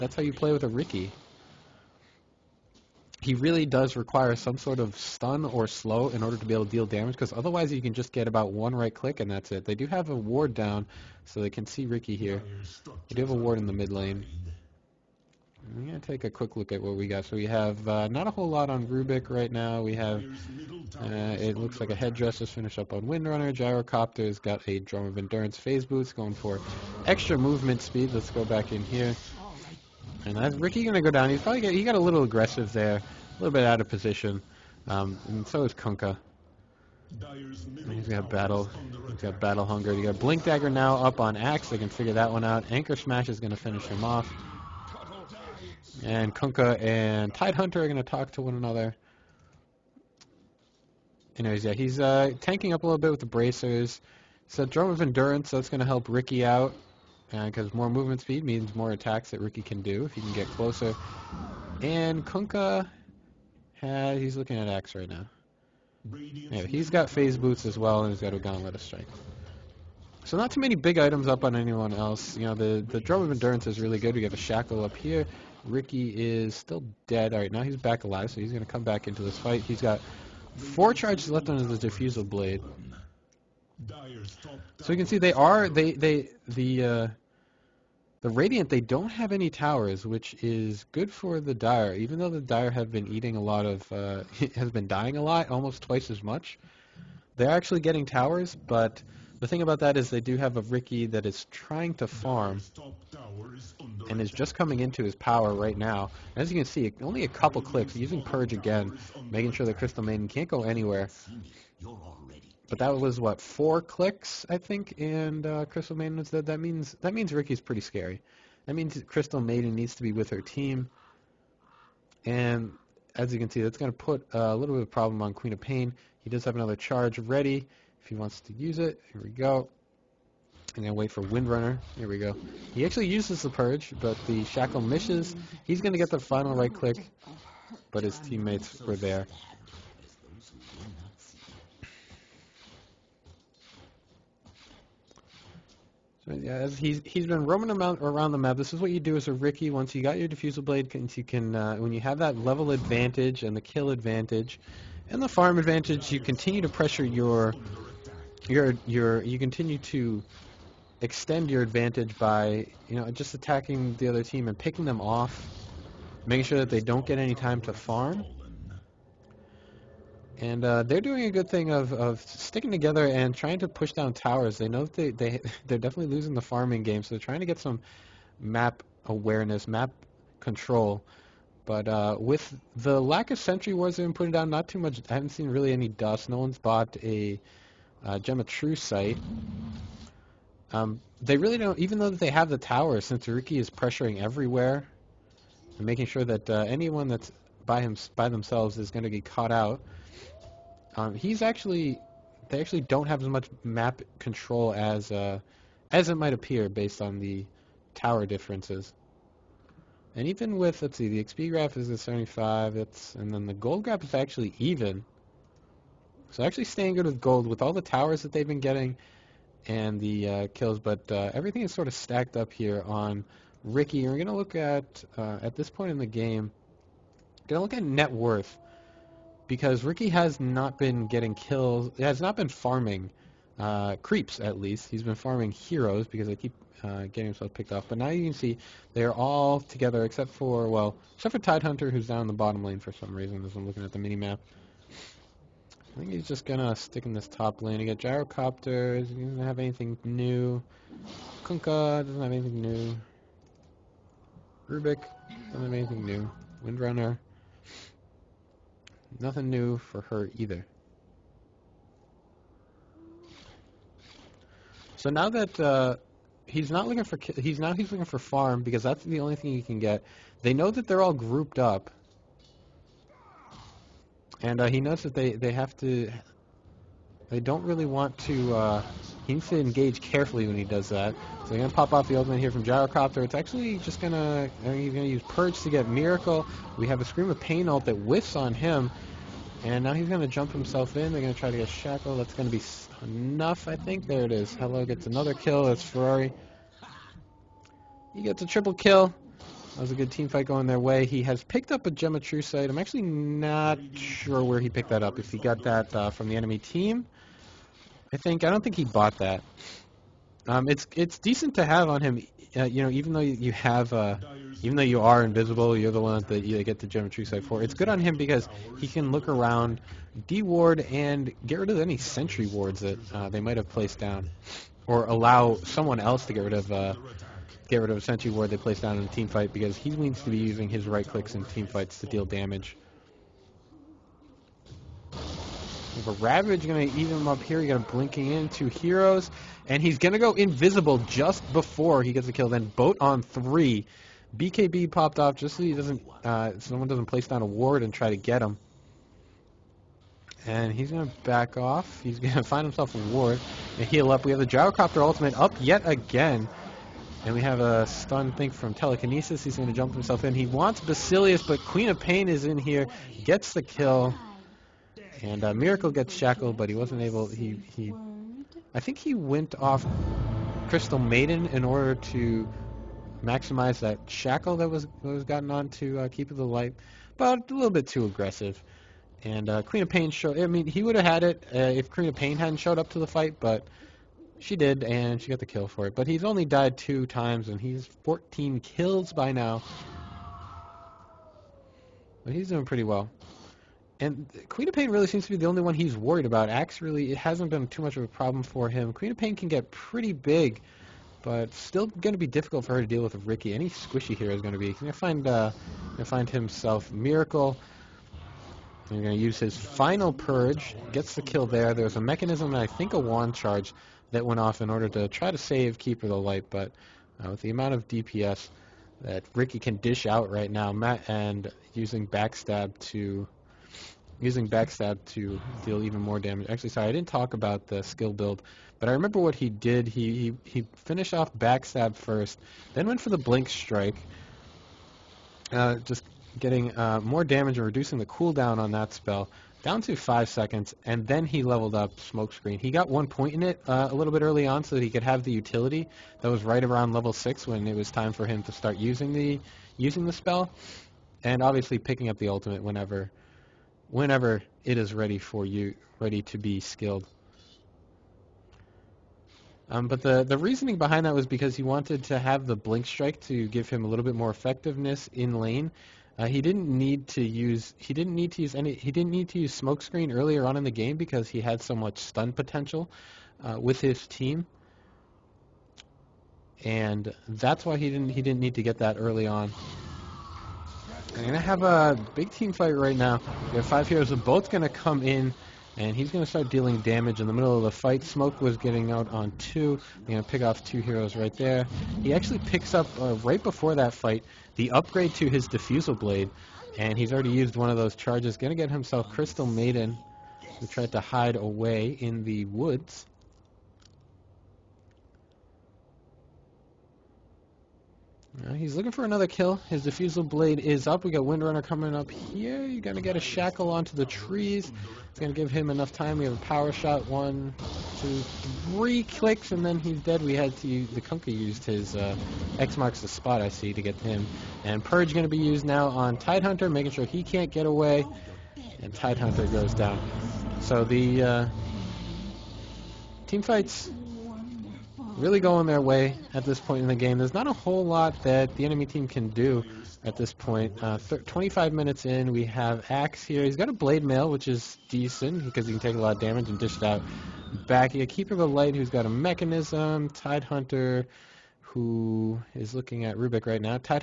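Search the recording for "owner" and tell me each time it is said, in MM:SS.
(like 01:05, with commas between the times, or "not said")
not said.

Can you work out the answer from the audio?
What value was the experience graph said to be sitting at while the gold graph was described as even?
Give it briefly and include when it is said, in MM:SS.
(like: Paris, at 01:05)
75, at 03:31.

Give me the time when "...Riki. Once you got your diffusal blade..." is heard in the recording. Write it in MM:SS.
02:29.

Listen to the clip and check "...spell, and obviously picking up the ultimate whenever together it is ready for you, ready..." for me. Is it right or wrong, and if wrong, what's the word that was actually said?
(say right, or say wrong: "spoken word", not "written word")
wrong: "whenever", not "together".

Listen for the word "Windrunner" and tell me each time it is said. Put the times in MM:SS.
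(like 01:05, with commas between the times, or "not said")
00:23, 02:11, 04:16, 08:31.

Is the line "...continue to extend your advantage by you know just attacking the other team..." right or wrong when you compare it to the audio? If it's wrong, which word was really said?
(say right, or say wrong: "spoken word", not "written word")
right.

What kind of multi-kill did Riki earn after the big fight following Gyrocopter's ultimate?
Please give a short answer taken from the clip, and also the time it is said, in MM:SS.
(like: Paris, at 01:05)
Triple kill, at 04:58.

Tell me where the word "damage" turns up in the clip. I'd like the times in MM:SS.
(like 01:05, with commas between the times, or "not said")
00:06, 05:32, 07:06, 07:17, 08:06, 09:06.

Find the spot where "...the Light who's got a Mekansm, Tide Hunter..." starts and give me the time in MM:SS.
09:08.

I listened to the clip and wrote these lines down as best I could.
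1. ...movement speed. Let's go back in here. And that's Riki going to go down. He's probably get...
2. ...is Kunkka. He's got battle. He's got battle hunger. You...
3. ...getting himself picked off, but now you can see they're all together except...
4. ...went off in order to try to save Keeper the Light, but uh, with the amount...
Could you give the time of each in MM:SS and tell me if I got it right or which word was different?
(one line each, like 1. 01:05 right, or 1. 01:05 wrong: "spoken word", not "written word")
1. 00:27 right
2. 00:35 right
3. 03:57 right
4. 06:54 right.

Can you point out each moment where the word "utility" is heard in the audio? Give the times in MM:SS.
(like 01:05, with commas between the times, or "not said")
07:25.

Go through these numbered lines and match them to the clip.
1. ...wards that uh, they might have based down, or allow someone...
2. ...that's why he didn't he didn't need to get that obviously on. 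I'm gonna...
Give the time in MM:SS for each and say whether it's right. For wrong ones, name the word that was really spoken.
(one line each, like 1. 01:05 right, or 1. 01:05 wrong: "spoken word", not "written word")
1. 05:22 wrong: "placed", not "based"
2. 07:57 wrong: "early", not "obviously".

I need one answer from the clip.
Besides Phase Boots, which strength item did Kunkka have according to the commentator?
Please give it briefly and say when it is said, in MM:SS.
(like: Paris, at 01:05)
Gauntlet of Strength, at 01:08.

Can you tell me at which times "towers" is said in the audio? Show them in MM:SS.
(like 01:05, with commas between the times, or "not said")
01:29, 01:38, 02:54, 03:12, 03:27, 03:37.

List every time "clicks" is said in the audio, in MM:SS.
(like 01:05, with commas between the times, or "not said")
00:08, 01:47, 01:53, 02:16, 05:31, 08:39.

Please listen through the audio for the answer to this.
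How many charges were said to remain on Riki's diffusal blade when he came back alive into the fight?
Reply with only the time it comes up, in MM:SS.
01:20.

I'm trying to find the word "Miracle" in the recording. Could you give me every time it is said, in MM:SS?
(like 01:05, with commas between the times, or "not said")
04:45, 06:05, 06:46.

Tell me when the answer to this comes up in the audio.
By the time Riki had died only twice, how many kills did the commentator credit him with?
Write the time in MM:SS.
06:28.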